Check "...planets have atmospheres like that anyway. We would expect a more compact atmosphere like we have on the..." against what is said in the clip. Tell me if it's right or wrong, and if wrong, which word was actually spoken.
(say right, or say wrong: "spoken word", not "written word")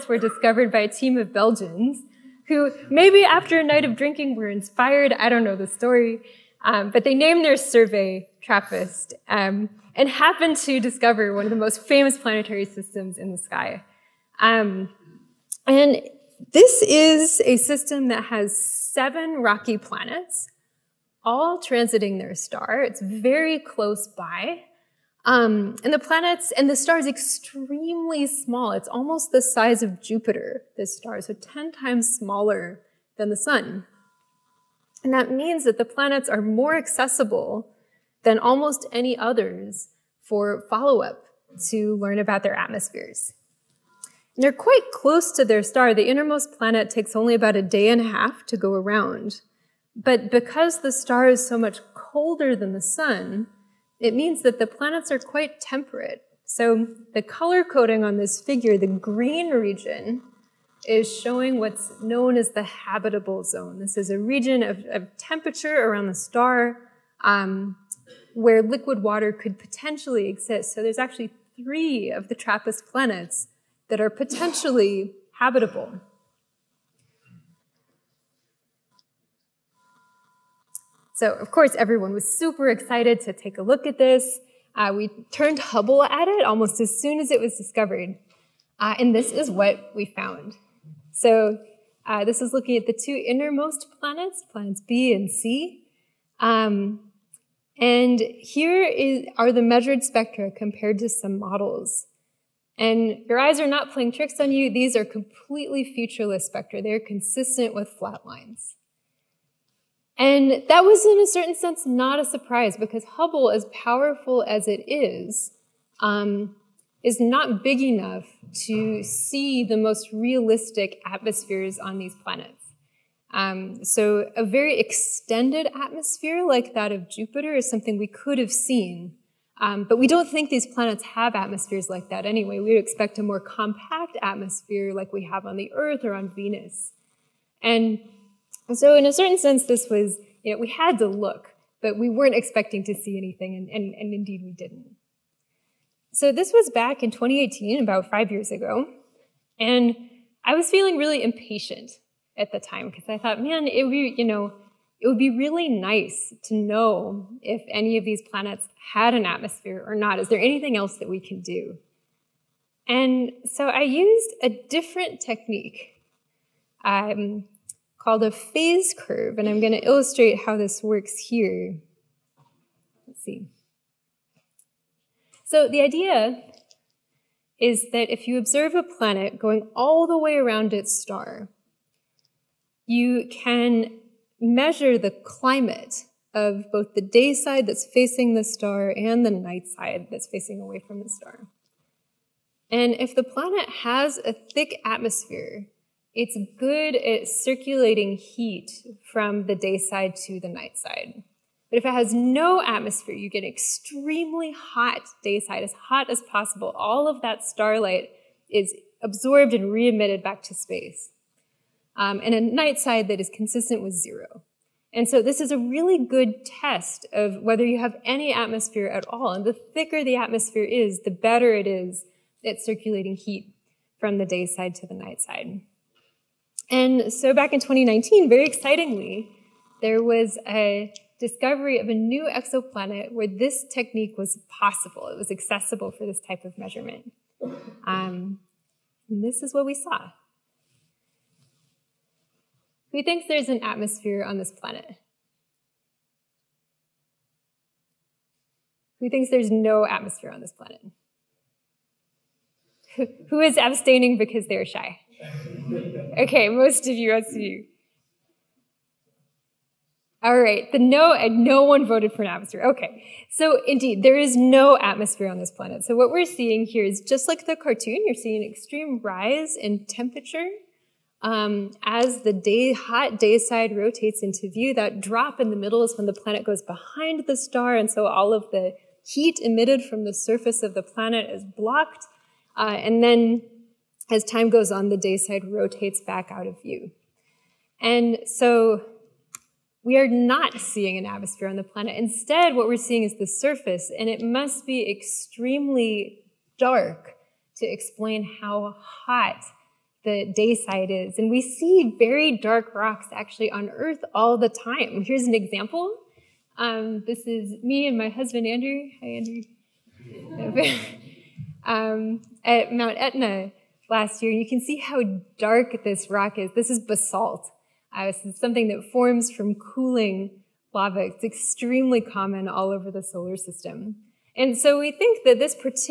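right.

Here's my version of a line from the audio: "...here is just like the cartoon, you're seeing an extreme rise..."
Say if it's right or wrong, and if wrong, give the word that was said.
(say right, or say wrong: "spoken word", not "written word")
right.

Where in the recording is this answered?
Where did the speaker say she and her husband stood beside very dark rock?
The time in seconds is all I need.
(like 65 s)
312 s.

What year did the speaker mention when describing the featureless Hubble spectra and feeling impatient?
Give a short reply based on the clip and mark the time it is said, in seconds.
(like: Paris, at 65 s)
2018, at 147 s.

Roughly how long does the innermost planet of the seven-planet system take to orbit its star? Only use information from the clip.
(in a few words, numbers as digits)
a day and a half.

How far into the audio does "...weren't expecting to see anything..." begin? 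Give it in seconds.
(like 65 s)
142 s.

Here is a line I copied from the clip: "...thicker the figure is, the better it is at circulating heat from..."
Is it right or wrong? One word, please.
wrong.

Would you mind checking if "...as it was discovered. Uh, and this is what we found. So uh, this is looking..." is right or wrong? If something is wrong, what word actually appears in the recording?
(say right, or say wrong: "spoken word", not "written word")
right.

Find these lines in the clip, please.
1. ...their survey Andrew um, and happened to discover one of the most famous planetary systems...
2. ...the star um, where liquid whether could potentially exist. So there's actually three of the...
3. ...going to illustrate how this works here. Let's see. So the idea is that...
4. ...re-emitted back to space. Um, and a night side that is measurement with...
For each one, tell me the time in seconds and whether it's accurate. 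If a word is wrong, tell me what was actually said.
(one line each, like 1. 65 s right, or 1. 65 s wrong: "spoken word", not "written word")
1. 7 s wrong: "TRAPPIST", not "Andrew"
2. 66 s wrong: "water", not "whether"
3. 169 s right
4. 209 s wrong: "consistent", not "measurement".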